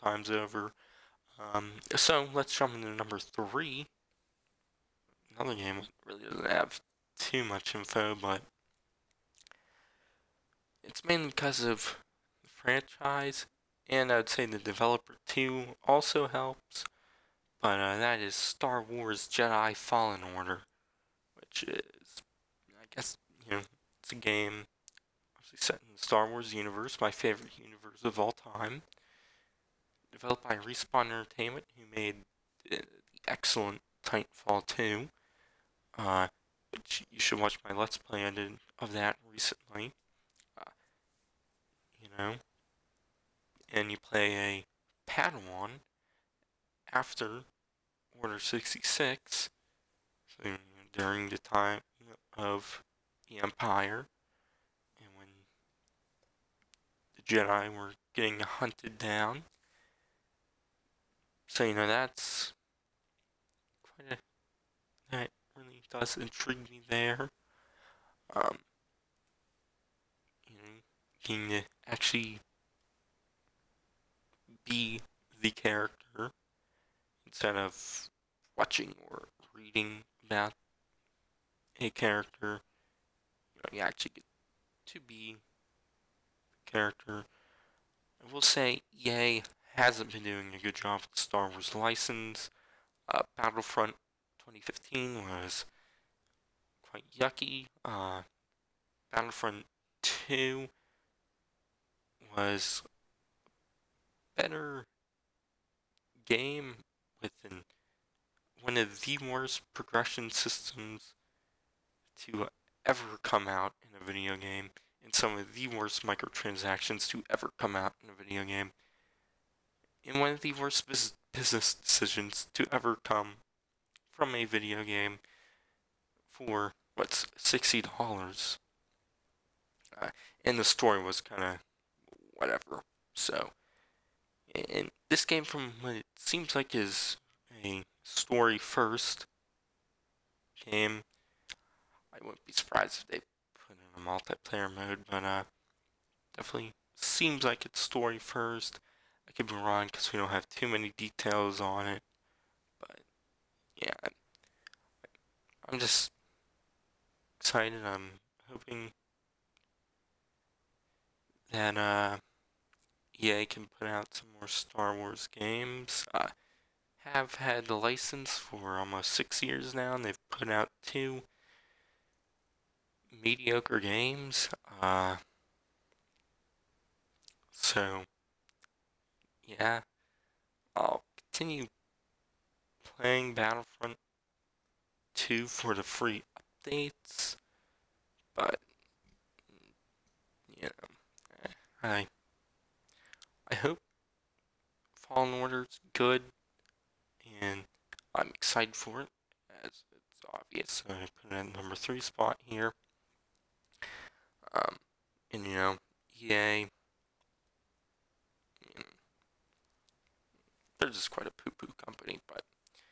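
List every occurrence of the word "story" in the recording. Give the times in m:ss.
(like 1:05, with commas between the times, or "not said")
2:10, 2:18, 2:27.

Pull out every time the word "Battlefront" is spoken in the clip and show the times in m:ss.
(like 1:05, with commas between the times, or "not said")
1:33, 1:39, 3:03.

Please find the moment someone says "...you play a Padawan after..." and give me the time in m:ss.
0:43.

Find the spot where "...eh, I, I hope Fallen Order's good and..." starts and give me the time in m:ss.
3:11.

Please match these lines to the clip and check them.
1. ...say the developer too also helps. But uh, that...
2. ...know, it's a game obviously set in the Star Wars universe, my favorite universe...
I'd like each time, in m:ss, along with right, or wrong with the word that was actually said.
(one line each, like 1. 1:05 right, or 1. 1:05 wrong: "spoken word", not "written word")
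1. 0:14 right
2. 0:23 right.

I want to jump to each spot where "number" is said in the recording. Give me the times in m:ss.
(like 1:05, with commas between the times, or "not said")
0:02, 3:21.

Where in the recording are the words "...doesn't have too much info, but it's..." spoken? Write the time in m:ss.
0:06.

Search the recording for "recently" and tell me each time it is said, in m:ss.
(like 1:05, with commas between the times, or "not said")
0:39.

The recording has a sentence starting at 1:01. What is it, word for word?
So, you know, that's quite a.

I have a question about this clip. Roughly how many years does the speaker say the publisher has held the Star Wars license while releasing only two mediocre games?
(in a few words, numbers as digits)
almost 6 years.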